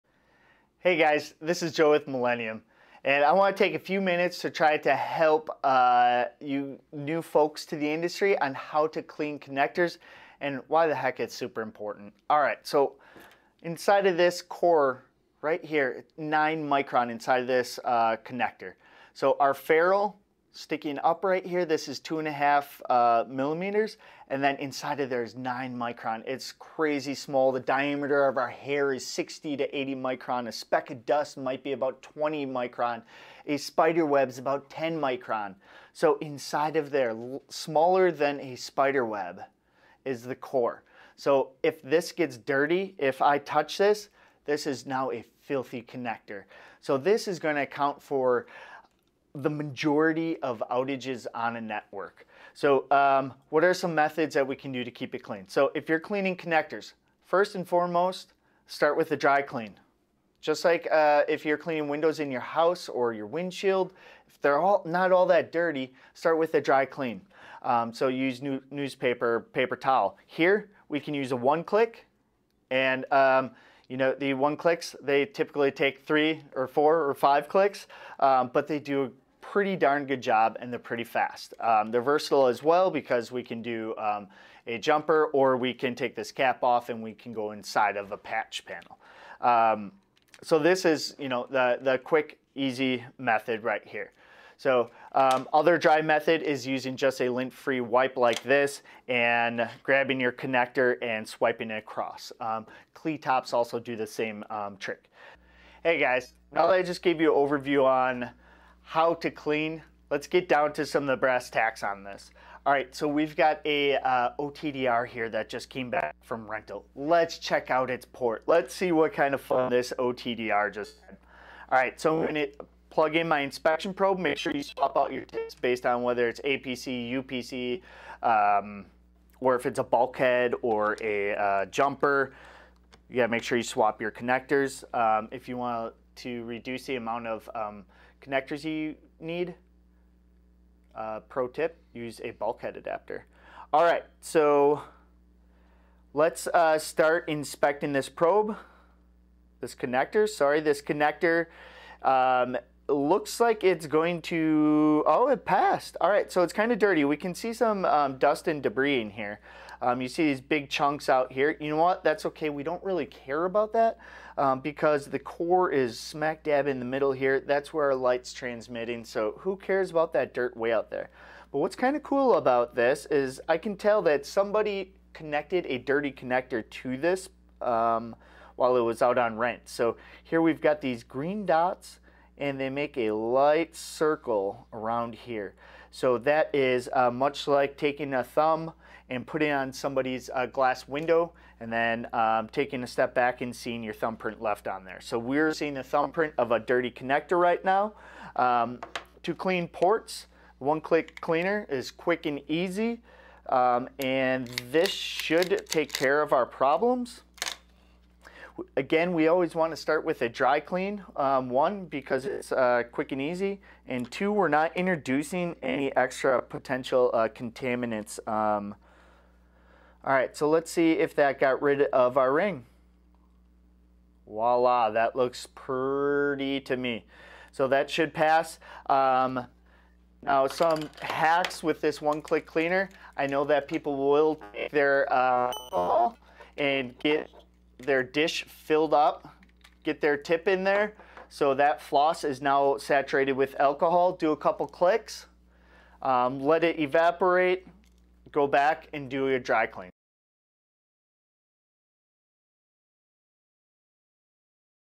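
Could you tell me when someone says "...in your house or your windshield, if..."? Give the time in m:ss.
1:02.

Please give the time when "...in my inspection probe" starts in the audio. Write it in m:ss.
2:03.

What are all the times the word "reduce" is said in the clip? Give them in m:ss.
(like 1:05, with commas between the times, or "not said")
2:16.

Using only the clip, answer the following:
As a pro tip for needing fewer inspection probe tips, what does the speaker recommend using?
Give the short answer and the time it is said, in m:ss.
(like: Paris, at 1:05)
bulkhead adapter, at 2:22.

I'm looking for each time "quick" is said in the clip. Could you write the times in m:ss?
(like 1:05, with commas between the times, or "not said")
1:31, 3:21, 3:32.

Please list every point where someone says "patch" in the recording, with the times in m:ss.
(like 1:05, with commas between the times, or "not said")
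1:28.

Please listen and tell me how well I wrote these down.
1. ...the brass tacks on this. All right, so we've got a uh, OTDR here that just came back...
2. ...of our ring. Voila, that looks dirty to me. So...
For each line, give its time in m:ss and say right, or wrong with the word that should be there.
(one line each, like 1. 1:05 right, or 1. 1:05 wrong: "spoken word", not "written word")
1. 1:51 right
2. 3:41 wrong: "pretty", not "dirty".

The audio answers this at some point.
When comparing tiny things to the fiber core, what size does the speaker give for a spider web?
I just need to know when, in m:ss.
0:34.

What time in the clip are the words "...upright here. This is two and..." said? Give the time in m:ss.
0:21.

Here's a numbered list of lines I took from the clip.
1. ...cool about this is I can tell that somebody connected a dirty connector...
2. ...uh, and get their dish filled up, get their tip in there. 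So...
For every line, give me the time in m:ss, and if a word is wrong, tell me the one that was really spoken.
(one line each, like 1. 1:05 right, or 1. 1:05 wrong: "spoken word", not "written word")
1. 2:52 right
2. 3:55 right.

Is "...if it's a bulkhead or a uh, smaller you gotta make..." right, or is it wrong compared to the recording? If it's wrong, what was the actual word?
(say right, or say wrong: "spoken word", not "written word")
wrong: "jumper", not "smaller".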